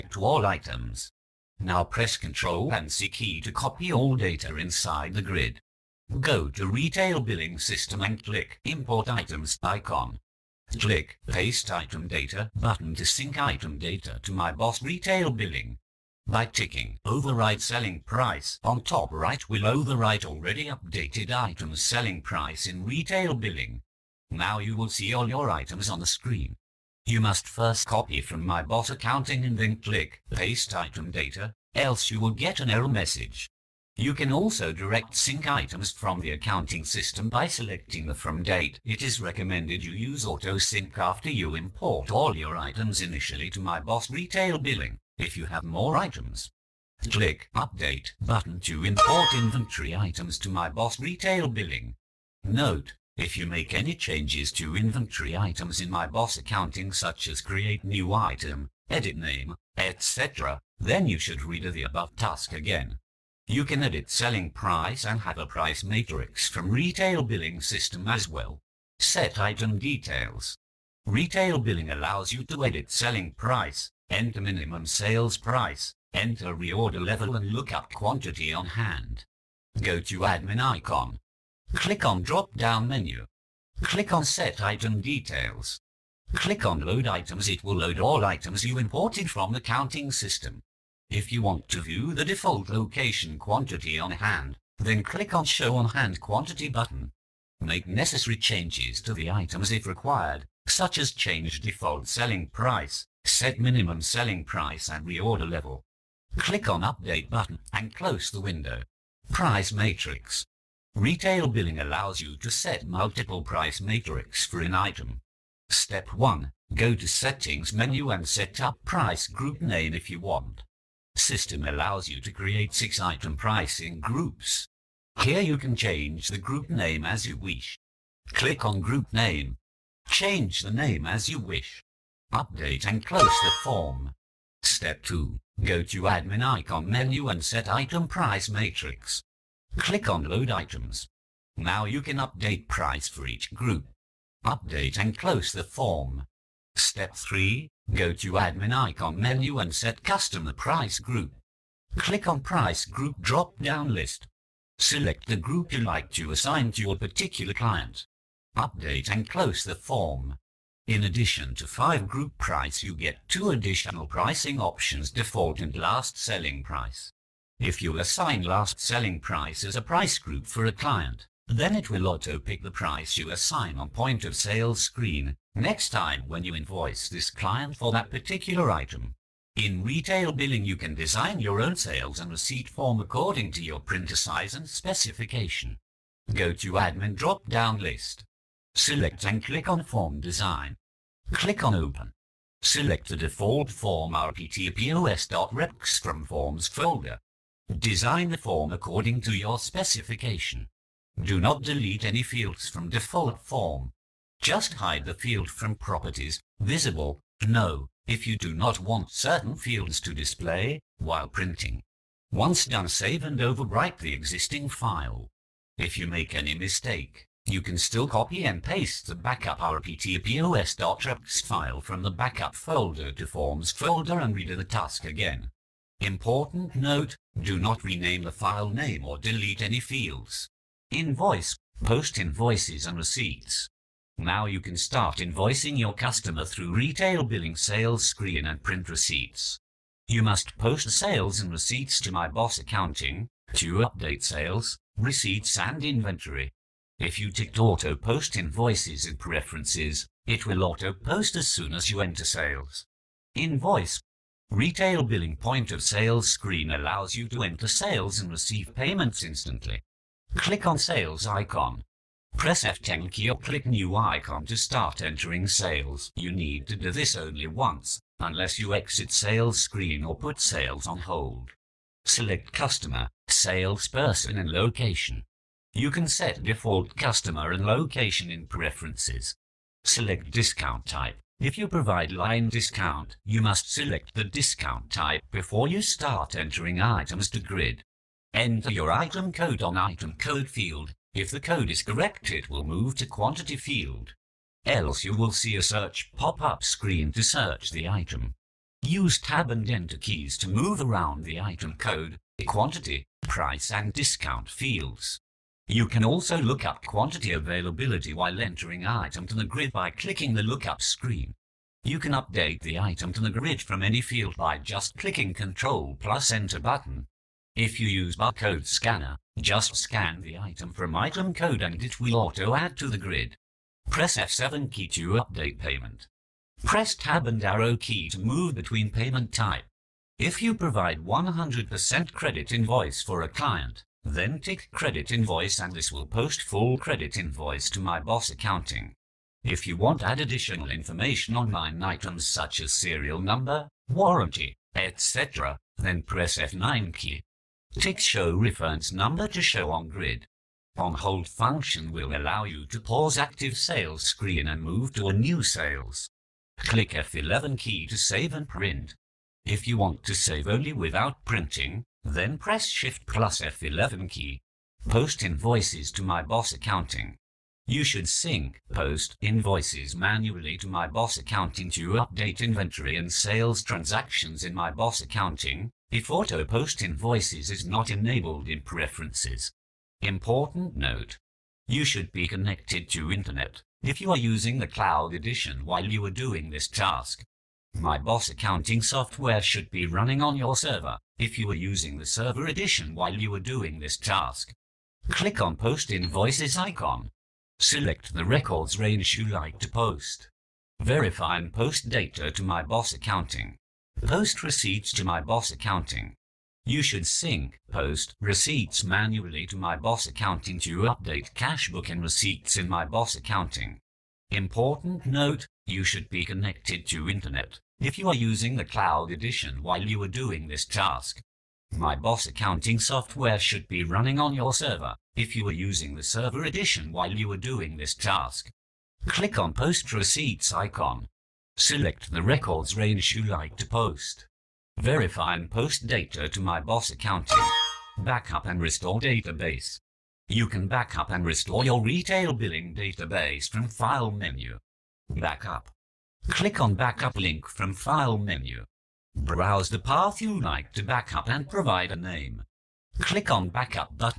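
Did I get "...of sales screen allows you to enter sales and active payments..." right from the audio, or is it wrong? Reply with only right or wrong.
wrong.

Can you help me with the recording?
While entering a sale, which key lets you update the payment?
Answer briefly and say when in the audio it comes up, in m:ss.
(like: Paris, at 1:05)
F7, at 5:24.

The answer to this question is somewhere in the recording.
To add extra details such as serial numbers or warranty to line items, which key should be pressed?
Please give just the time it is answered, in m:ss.
5:46.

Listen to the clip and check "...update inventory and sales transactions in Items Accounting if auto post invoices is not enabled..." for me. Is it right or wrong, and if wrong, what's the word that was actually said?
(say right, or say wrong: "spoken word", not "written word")
wrong: "MYBOS", not "Items".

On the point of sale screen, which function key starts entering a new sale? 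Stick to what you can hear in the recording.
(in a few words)
F10.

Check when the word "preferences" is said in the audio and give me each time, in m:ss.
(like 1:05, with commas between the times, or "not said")
4:09, 4:38, 6:18.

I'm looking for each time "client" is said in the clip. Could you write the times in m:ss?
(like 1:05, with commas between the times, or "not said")
2:37, 2:50, 2:57, 5:33.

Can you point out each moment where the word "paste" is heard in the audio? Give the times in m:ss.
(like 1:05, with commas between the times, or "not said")
0:11, 0:30, 3:38.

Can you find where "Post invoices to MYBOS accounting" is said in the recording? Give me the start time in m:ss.
6:04.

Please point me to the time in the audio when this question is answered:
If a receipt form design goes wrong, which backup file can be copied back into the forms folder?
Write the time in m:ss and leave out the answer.
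3:39.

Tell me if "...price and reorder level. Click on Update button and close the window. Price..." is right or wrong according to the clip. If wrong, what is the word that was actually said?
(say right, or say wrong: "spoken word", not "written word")
right.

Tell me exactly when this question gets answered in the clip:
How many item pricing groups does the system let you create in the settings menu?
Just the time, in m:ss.
2:02.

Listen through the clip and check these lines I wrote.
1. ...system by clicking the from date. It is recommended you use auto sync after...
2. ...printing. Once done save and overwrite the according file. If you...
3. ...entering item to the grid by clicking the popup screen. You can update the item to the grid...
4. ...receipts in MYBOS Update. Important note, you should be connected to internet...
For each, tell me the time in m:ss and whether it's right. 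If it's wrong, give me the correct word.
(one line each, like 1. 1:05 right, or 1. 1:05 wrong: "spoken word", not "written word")
1. 0:36 wrong: "selecting", not "clicking"
2. 3:31 wrong: "existing", not "according"
3. 5:08 wrong: "lookup", not "popup"
4. 6:52 wrong: "Accounting", not "Update".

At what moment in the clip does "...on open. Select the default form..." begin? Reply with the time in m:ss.
3:11.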